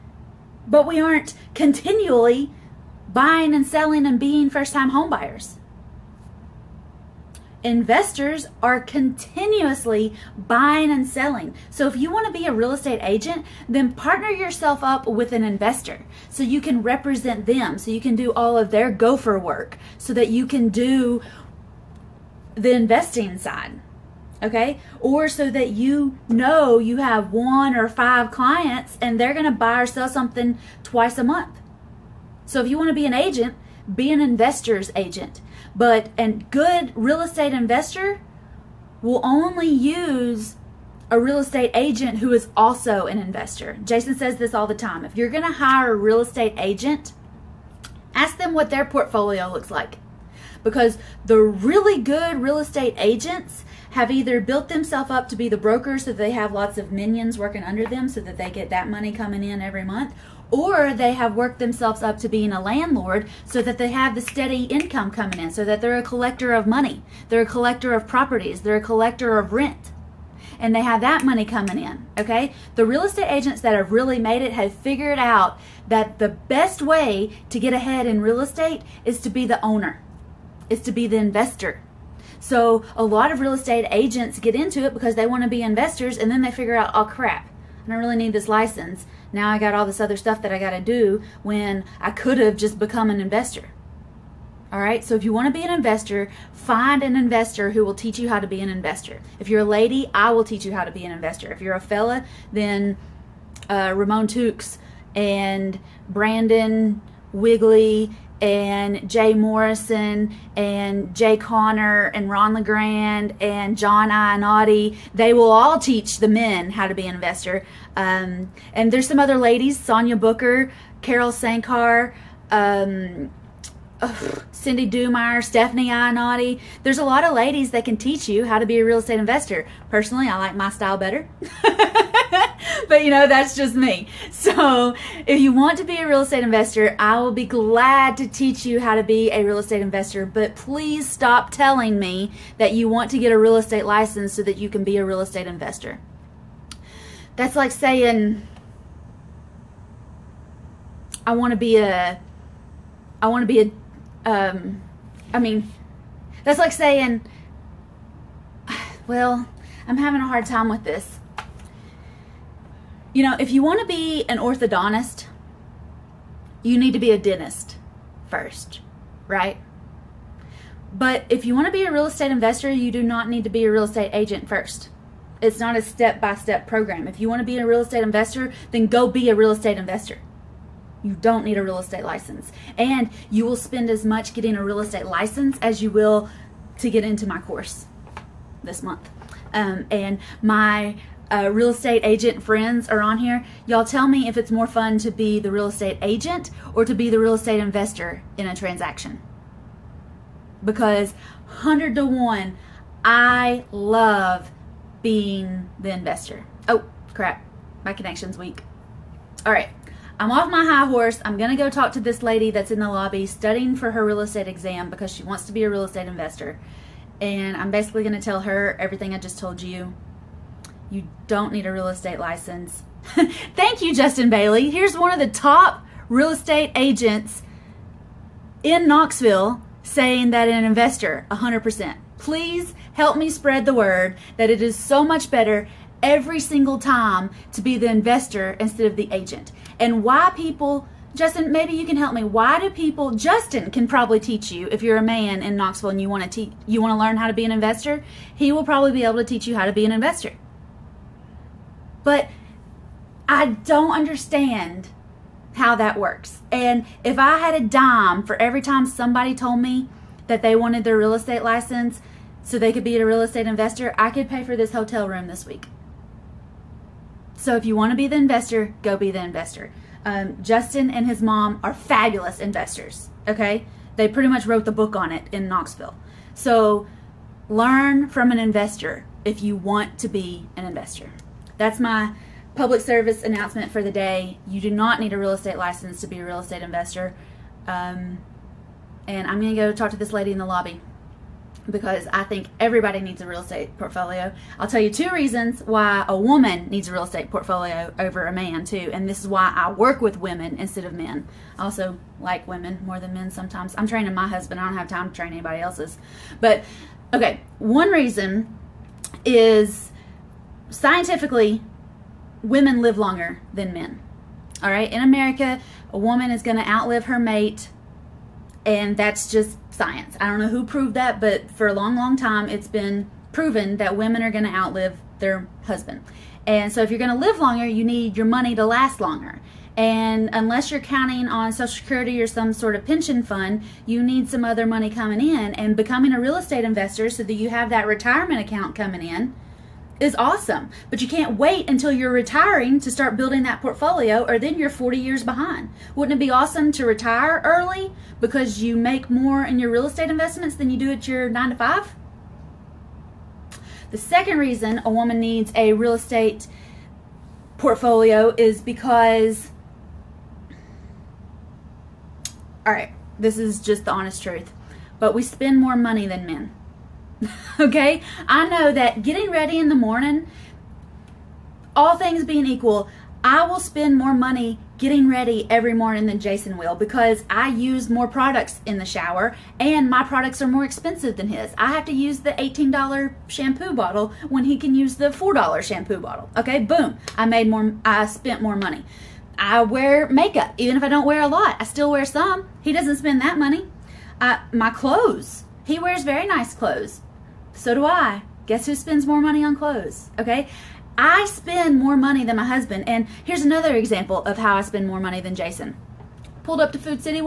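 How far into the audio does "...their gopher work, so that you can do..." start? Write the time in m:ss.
0:18.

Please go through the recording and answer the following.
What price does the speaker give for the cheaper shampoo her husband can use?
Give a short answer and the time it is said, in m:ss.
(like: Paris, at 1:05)
$4, at 6:25.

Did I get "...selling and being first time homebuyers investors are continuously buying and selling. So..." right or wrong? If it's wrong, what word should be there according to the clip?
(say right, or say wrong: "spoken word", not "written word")
right.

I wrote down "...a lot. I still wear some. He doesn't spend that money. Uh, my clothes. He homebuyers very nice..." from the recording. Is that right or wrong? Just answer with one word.
wrong.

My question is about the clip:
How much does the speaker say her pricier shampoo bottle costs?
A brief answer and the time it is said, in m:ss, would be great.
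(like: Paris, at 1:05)
$18, at 6:22.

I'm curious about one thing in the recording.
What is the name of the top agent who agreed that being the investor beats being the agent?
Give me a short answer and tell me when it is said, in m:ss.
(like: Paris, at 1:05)
Justin Bailey, at 3:43.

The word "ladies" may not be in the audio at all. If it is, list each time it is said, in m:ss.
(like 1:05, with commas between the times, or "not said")
1:59, 2:07.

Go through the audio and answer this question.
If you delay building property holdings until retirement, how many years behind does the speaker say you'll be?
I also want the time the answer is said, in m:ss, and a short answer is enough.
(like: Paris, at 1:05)
40 years, at 5:44.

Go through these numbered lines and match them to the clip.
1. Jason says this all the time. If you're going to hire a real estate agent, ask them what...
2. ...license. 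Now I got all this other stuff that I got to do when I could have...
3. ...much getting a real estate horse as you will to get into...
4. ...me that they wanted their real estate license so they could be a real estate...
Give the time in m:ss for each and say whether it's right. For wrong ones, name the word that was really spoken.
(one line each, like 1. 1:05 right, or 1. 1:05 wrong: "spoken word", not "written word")
1. 0:43 right
2. 1:28 right
3. 3:04 wrong: "license", not "horse"
4. 4:19 right.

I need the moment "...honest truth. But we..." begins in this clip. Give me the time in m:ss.
6:03.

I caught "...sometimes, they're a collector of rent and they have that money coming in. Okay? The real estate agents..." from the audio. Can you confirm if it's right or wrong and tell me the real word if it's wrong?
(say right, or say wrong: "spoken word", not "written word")
wrong: "properties", not "sometimes".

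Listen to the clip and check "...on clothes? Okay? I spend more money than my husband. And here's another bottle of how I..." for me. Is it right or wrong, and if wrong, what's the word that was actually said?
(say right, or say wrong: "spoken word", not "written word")
wrong: "example", not "bottle".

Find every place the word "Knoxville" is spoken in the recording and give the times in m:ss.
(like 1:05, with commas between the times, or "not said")
3:48, 4:05, 4:35.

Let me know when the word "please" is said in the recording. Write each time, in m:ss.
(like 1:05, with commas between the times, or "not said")
2:20, 3:52.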